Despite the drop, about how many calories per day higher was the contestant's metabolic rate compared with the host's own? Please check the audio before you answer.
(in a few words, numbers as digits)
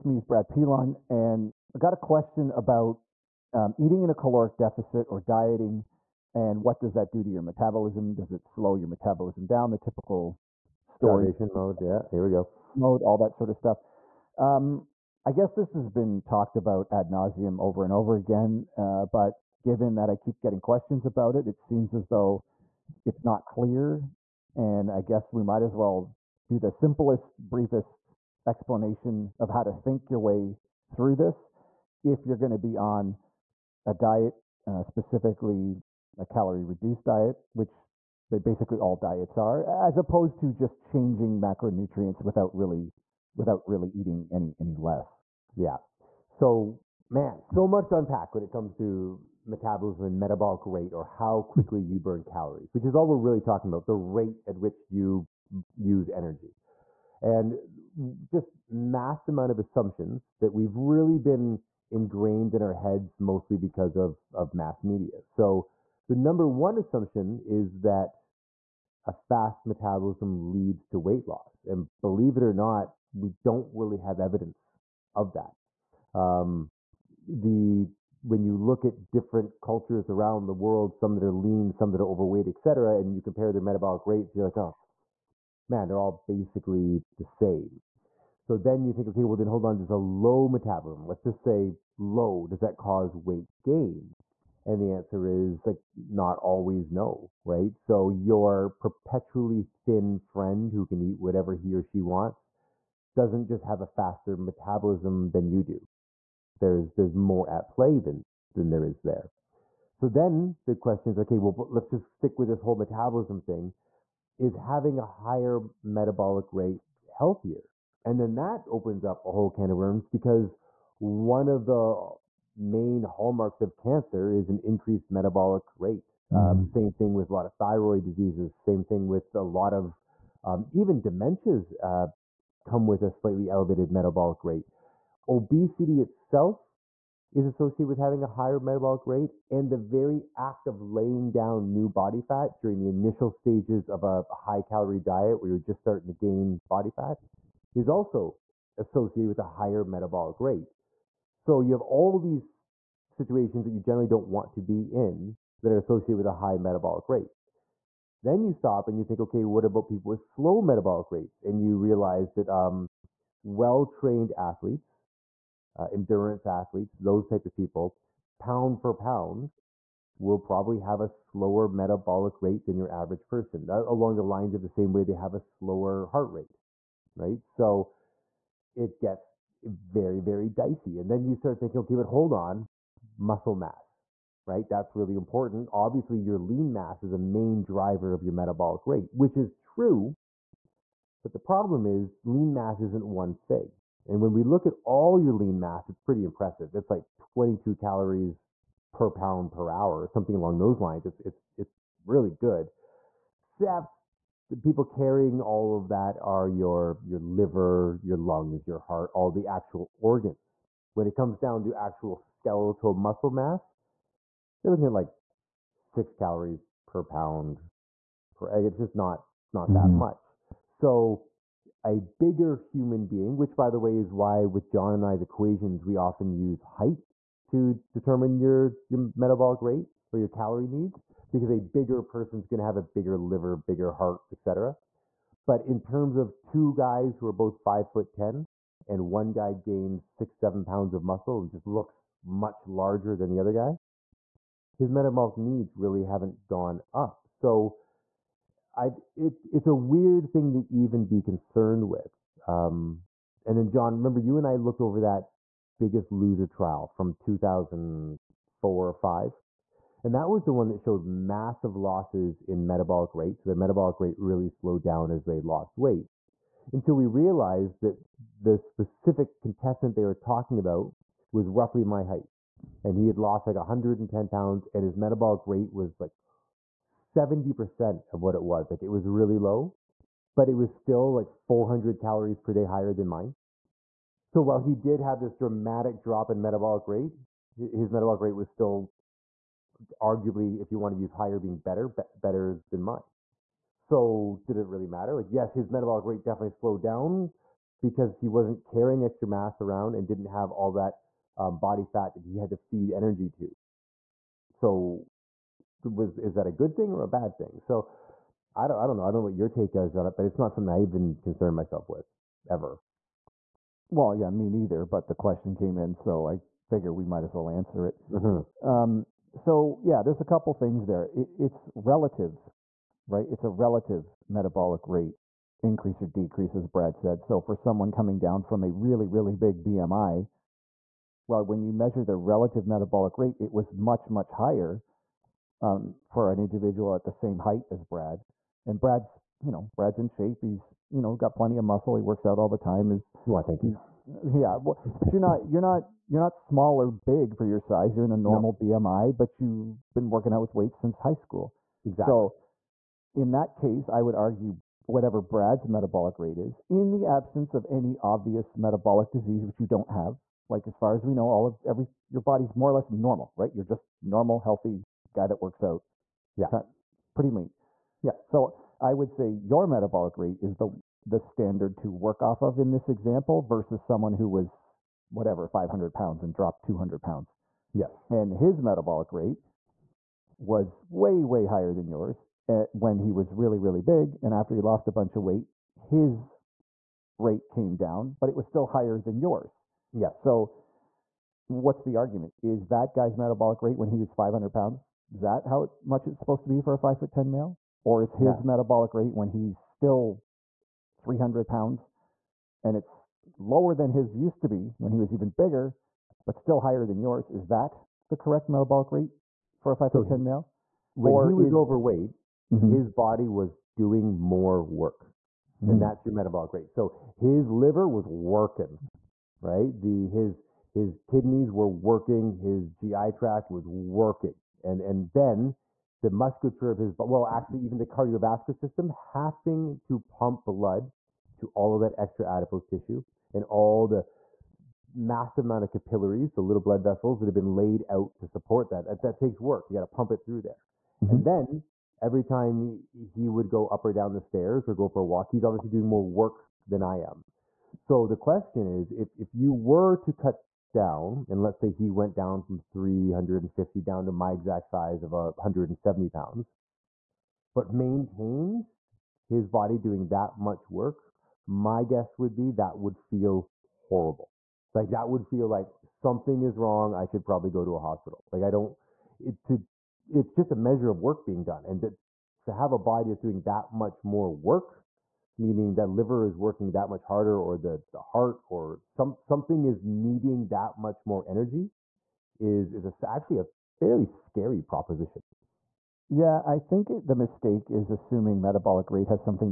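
400.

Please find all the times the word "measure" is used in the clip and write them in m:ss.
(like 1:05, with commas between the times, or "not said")
5:31, 7:50.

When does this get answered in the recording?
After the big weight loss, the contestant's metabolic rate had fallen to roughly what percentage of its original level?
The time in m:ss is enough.
4:36.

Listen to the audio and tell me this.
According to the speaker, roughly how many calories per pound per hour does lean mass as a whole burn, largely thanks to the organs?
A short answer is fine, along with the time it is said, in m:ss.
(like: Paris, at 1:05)
22, at 3:17.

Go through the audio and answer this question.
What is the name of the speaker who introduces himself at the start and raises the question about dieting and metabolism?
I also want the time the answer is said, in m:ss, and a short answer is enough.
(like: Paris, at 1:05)
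Brad Pilon, at 0:00.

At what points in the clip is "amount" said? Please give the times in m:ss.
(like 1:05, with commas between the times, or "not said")
0:59, 7:15.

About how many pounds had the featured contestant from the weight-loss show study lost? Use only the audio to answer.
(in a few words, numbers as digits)
110 pounds.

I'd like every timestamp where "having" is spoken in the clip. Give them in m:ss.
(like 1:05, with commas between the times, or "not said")
1:54, 2:17, 7:08.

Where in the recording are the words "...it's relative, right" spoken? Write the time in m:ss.
5:21.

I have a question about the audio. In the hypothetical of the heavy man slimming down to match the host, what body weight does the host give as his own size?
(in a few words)
170 pounds.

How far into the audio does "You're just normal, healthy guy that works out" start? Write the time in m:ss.
6:03.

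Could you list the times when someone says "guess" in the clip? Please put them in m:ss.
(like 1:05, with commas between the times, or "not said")
0:15, 0:24, 7:41.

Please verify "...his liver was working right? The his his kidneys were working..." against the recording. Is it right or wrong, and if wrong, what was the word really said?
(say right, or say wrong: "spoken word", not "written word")
right.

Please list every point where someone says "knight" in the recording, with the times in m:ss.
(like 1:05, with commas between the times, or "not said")
not said.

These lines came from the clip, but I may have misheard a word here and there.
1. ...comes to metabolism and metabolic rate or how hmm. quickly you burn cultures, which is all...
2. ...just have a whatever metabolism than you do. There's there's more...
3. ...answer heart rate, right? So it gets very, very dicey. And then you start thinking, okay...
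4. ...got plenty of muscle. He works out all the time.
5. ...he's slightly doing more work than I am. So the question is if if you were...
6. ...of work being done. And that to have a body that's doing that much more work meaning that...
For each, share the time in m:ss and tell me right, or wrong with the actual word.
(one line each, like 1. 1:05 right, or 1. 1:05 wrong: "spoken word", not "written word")
1. 0:48 wrong: "calories", not "cultures"
2. 1:43 wrong: "faster", not "whatever"
3. 2:55 wrong: "slower", not "answer"
4. 5:41 right
5. 7:25 wrong: "obviously", not "slightly"
6. 7:50 right.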